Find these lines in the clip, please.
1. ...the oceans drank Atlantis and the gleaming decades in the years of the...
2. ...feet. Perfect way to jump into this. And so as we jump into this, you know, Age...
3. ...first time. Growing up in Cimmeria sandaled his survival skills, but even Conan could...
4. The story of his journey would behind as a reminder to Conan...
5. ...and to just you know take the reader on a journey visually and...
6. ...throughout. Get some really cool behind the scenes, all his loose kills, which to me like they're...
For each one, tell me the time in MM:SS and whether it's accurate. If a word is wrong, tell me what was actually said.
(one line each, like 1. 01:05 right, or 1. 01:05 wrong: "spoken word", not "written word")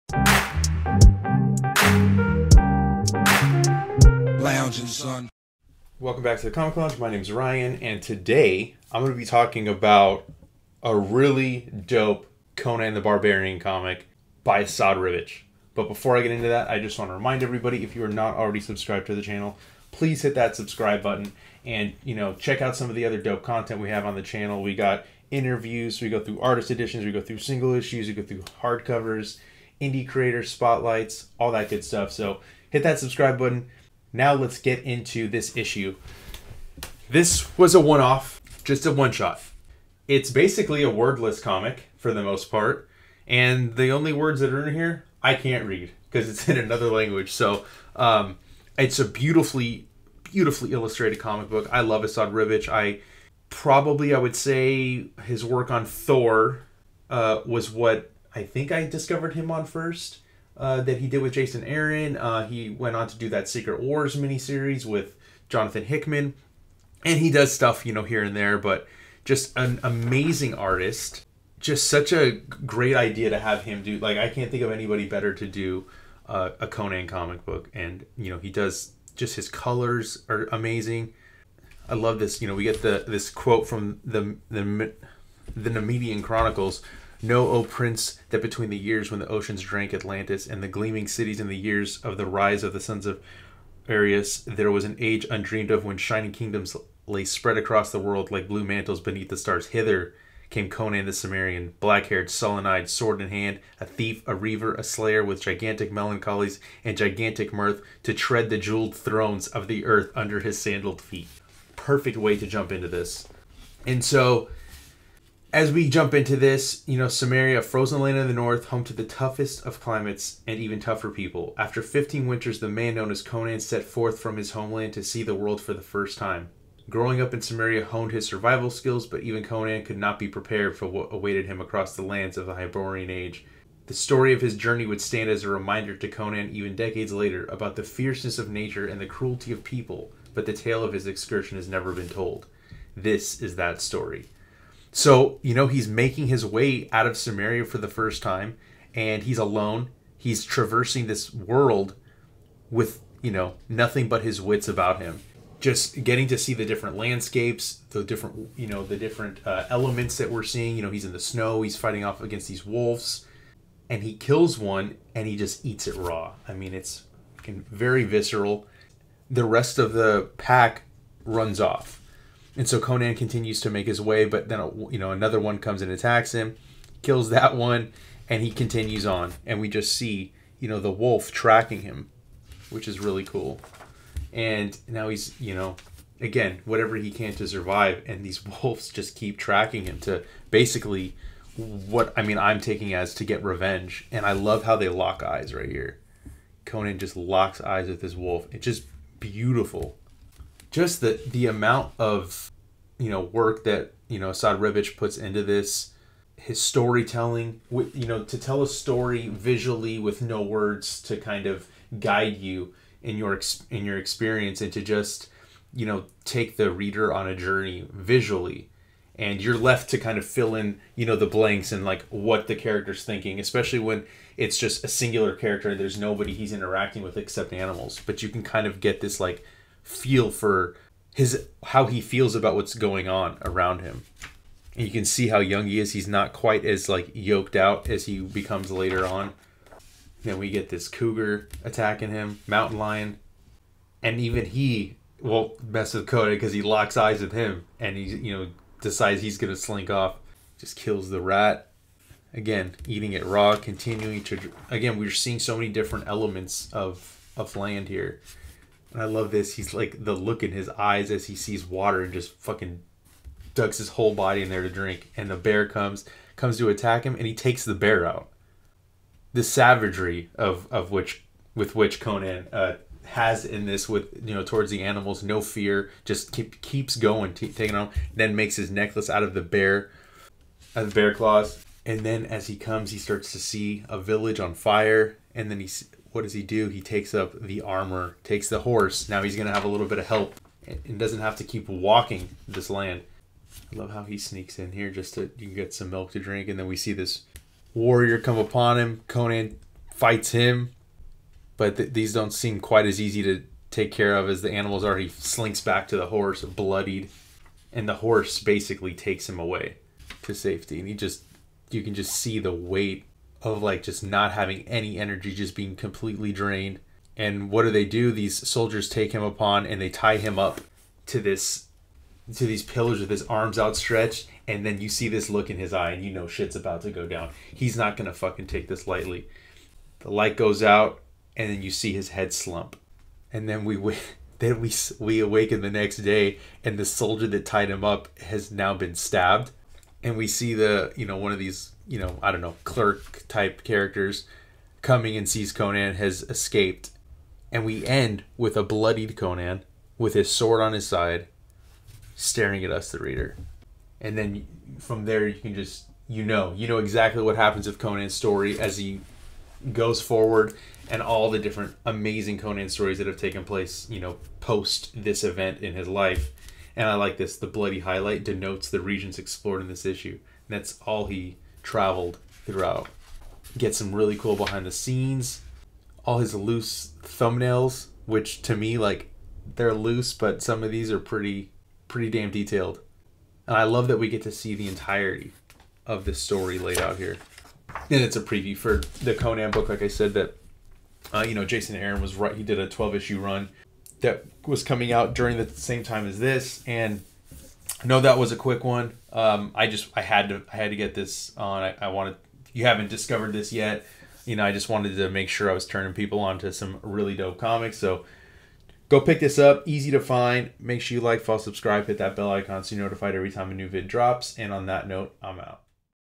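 1. 01:29 wrong: "cities", not "decades"
2. 01:51 wrong: "Cimmeria", not "Age"
3. 02:05 wrong: "honed", not "sandaled"
4. 02:13 wrong: "stand", not "behind"
5. 03:34 right
6. 06:12 wrong: "thumbnails", not "kills".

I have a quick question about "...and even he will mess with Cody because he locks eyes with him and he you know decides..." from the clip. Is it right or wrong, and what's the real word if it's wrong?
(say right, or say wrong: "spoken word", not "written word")
right.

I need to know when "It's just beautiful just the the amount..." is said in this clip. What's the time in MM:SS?
03:18.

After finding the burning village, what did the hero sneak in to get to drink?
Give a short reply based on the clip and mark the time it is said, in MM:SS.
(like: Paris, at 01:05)
Milk, at 04:55.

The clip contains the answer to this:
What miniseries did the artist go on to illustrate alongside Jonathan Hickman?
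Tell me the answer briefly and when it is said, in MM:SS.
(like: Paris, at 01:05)
Secret Wars, at 01:03.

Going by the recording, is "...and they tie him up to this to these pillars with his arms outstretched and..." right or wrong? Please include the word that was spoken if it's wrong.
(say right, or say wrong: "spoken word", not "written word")
right.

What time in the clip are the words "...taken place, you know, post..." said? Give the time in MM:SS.
06:03.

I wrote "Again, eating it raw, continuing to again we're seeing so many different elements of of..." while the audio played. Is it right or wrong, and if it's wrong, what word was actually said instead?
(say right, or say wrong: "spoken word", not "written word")
right.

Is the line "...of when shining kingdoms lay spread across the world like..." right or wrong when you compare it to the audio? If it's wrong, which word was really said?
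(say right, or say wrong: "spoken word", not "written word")
right.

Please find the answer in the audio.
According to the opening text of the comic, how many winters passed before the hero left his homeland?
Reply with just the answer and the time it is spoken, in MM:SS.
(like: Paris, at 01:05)
15, at 02:01.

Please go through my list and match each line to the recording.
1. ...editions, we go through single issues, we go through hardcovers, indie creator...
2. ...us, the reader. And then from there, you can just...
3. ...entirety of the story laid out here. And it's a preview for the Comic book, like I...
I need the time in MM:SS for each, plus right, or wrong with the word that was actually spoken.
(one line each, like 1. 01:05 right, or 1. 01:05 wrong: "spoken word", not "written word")
1. 00:26 right
2. 05:52 right
3. 06:24 wrong: "Conan", not "Comic".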